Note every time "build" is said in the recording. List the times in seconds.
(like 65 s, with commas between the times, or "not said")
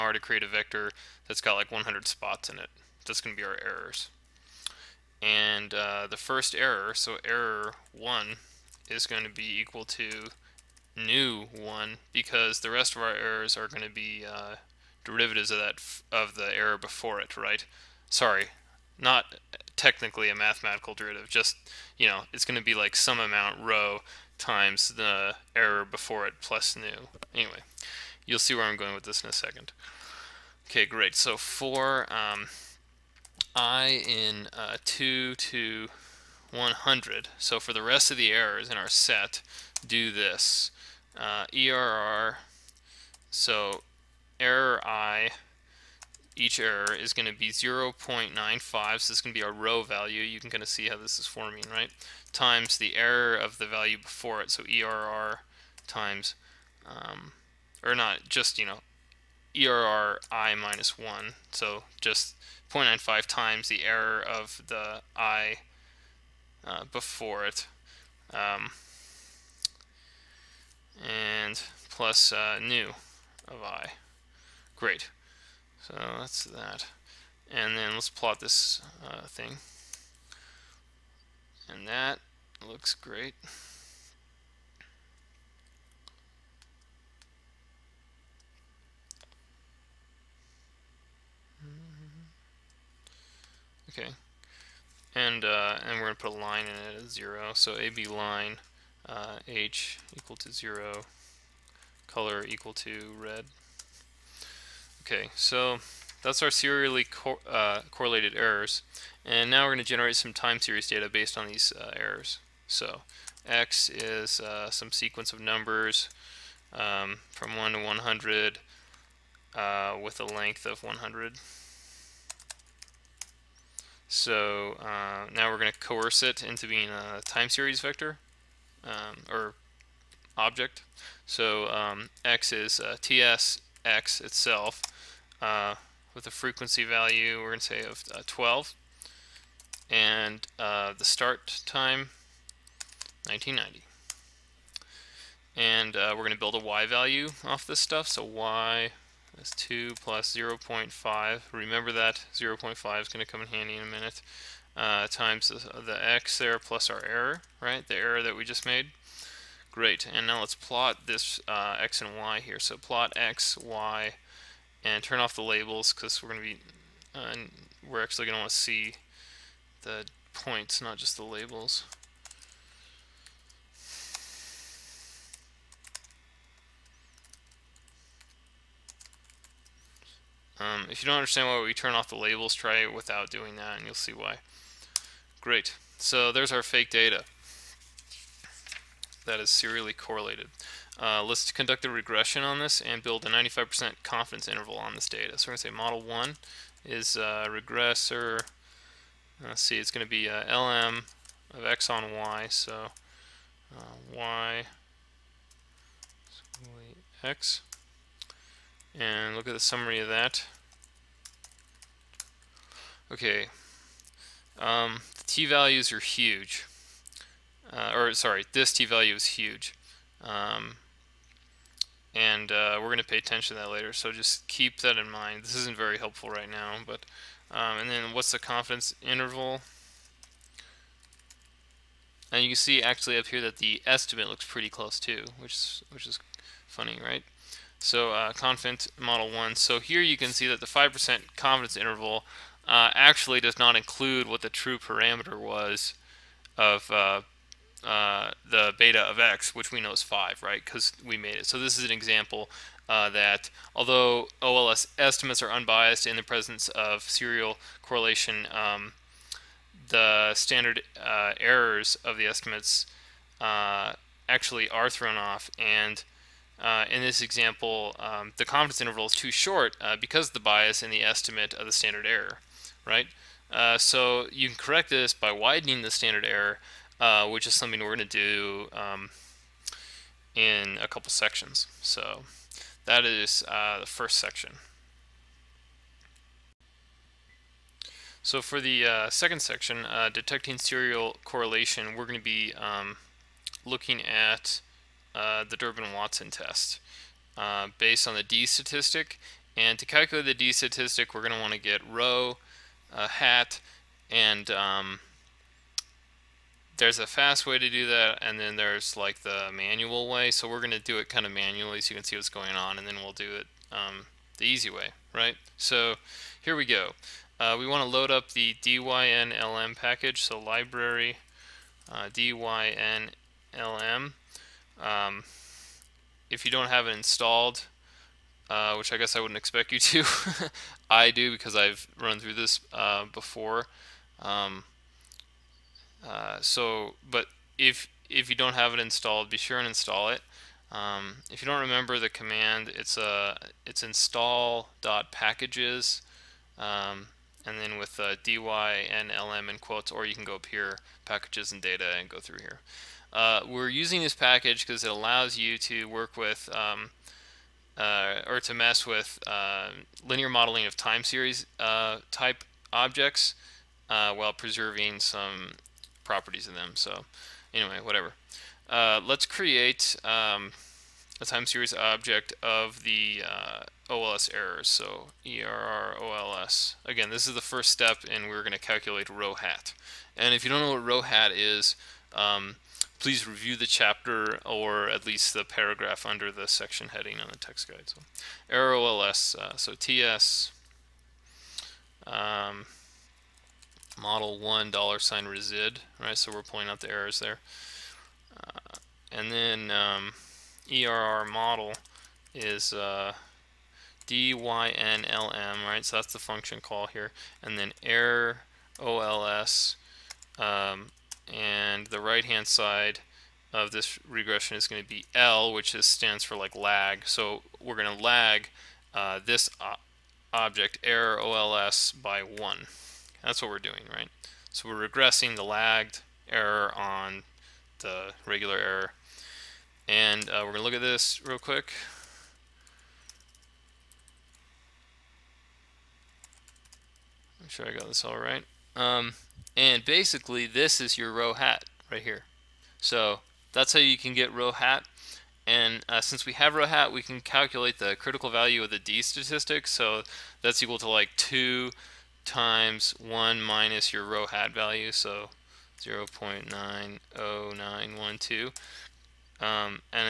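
146 s, 193 s.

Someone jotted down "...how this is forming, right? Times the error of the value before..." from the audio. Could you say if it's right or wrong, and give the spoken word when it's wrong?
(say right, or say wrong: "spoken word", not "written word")
right.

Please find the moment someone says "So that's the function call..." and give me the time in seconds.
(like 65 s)
405 s.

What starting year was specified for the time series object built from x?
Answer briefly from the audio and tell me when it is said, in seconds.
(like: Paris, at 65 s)
1990, at 143 s.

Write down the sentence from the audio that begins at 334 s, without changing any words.
Um, uh, so, but if if you don't have it installed, be sure and install it.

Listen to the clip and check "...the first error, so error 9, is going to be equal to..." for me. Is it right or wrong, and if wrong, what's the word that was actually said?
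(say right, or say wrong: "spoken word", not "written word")
wrong: "1", not "9".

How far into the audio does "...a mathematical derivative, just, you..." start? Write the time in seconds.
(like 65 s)
20 s.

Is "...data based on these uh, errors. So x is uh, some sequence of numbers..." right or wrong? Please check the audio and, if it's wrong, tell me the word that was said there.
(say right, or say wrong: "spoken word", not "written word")
right.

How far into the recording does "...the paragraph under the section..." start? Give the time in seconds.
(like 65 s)
385 s.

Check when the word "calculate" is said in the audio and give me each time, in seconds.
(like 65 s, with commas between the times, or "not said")
299 s, 378 s, 447 s.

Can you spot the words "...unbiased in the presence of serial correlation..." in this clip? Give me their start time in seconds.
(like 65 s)
255 s.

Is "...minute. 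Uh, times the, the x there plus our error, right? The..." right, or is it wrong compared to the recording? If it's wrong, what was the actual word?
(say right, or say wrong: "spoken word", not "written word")
right.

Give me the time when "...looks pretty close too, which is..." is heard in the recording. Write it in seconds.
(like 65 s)
234 s.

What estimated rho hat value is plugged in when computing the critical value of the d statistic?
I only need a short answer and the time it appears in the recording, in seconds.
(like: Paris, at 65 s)
0.90912, at 455 s.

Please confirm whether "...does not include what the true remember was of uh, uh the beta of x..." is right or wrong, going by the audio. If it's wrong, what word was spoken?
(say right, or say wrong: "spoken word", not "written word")
wrong: "parameter", not "remember".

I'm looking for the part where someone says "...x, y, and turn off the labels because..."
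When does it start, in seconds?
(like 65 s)
163 s.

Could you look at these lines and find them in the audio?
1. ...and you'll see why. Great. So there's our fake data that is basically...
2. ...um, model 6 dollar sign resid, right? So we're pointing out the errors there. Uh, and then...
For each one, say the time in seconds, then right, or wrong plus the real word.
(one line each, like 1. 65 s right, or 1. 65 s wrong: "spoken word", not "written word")
1. 183 s wrong: "serially", not "basically"
2. 392 s wrong: "1", not "6".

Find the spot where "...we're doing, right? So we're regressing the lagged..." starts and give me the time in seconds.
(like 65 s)
423 s.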